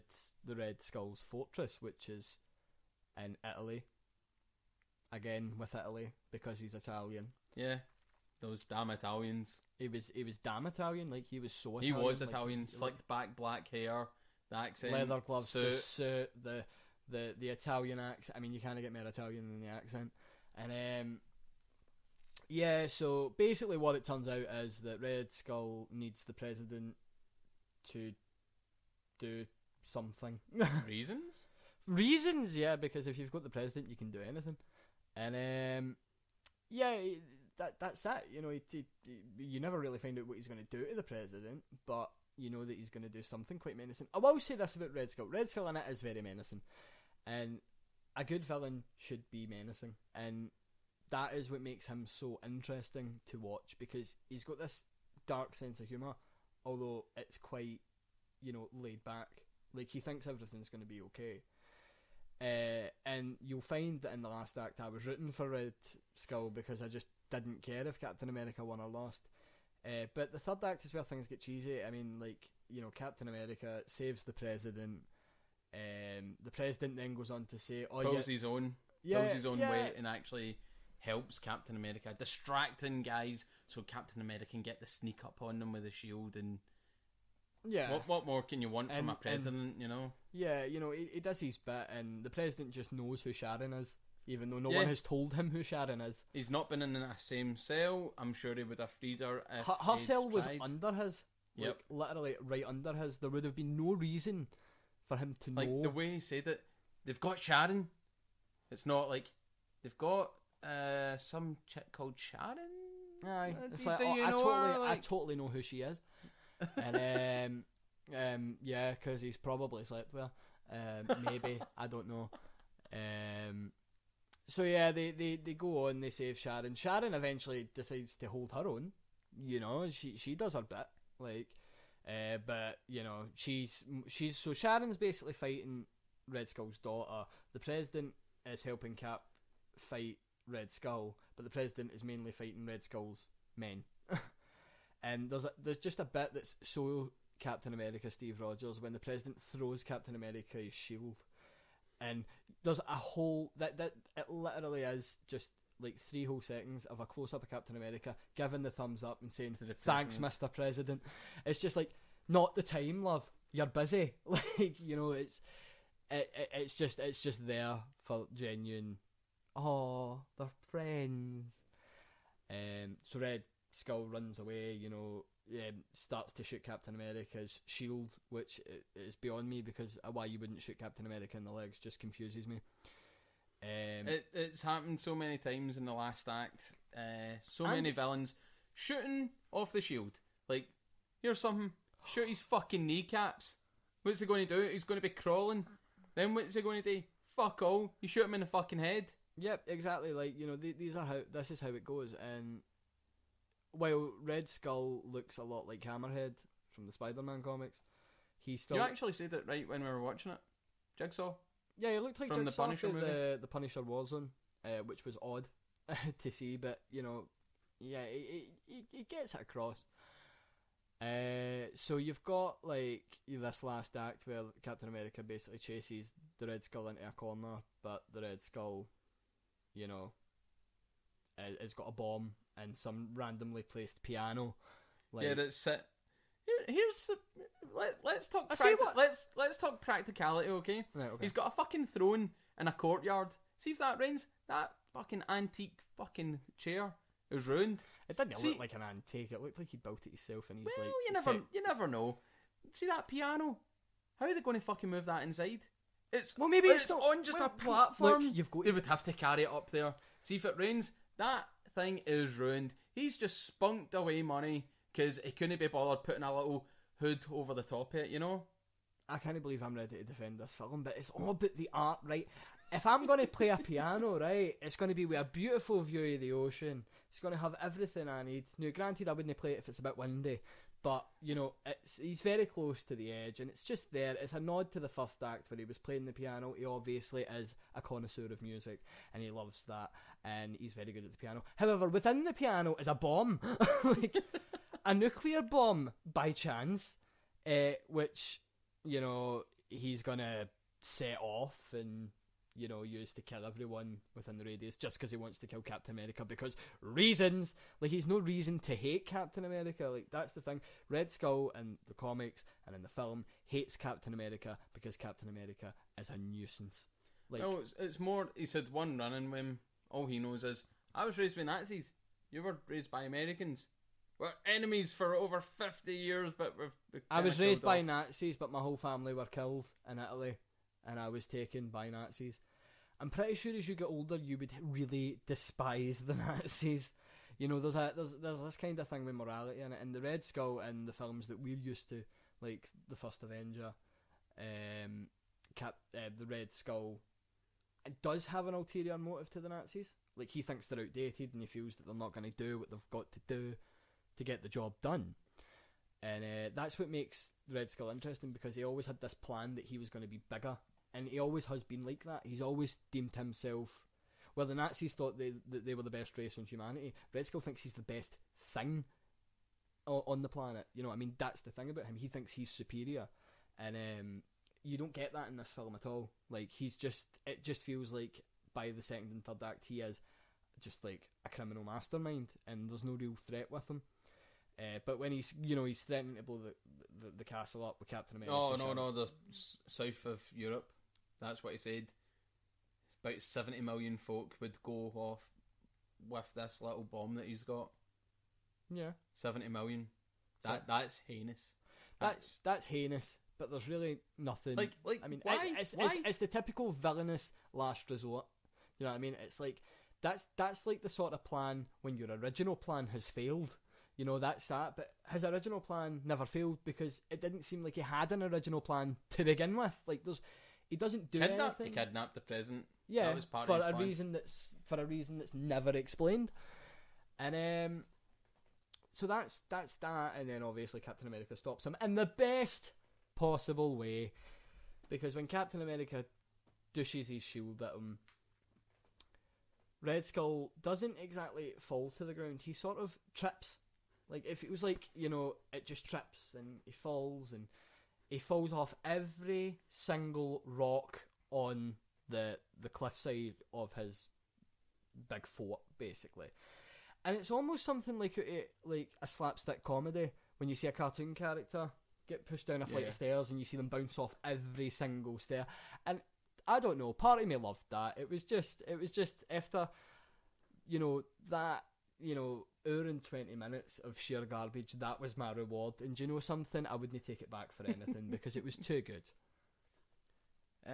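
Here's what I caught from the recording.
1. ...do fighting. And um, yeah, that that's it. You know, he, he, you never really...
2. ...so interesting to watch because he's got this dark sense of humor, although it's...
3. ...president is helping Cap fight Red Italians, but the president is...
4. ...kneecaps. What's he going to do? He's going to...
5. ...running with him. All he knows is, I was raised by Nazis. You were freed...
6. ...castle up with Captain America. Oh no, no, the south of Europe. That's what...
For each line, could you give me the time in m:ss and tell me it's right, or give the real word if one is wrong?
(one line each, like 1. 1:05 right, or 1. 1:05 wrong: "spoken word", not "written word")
1. 0:34 wrong: "anything", not "fighting"
2. 0:52 right
3. 2:17 wrong: "Skull", not "Italians"
4. 3:12 right
5. 5:18 wrong: "raised", not "freed"
6. 6:27 right.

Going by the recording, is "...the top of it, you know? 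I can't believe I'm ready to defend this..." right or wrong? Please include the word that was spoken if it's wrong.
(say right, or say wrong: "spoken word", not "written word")
right.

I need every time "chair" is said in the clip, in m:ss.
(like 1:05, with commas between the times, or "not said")
4:06.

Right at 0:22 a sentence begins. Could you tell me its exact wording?
Yeah, so basically, what it turns out is that Red Skull needs the president to do something.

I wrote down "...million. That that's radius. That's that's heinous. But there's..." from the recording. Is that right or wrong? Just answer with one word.
wrong.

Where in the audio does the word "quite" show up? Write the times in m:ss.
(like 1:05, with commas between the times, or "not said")
0:43, 0:57.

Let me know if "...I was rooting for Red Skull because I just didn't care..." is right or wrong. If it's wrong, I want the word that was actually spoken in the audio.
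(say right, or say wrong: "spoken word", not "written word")
right.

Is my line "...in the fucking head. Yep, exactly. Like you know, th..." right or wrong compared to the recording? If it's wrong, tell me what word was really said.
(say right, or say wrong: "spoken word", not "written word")
right.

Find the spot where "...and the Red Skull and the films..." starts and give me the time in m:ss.
5:39.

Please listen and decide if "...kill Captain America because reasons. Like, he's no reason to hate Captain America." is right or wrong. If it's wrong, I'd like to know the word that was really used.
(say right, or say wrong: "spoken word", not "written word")
right.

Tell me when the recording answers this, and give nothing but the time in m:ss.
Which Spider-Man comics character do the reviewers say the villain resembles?
3:25.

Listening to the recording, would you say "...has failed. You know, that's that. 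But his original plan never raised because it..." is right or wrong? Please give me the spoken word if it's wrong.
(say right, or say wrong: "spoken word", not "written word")
wrong: "failed", not "raised".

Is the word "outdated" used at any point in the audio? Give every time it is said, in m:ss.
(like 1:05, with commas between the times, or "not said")
5:50.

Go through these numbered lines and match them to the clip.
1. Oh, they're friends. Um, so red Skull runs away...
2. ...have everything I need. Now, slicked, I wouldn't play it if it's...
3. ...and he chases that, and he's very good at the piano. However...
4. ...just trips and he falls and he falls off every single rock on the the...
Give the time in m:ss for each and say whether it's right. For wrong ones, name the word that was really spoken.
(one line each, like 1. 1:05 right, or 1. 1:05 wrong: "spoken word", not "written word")
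1. 2:49 right
2. 4:37 wrong: "granted", not "slicked"
3. 4:49 wrong: "loves", not "chases"
4. 7:25 right.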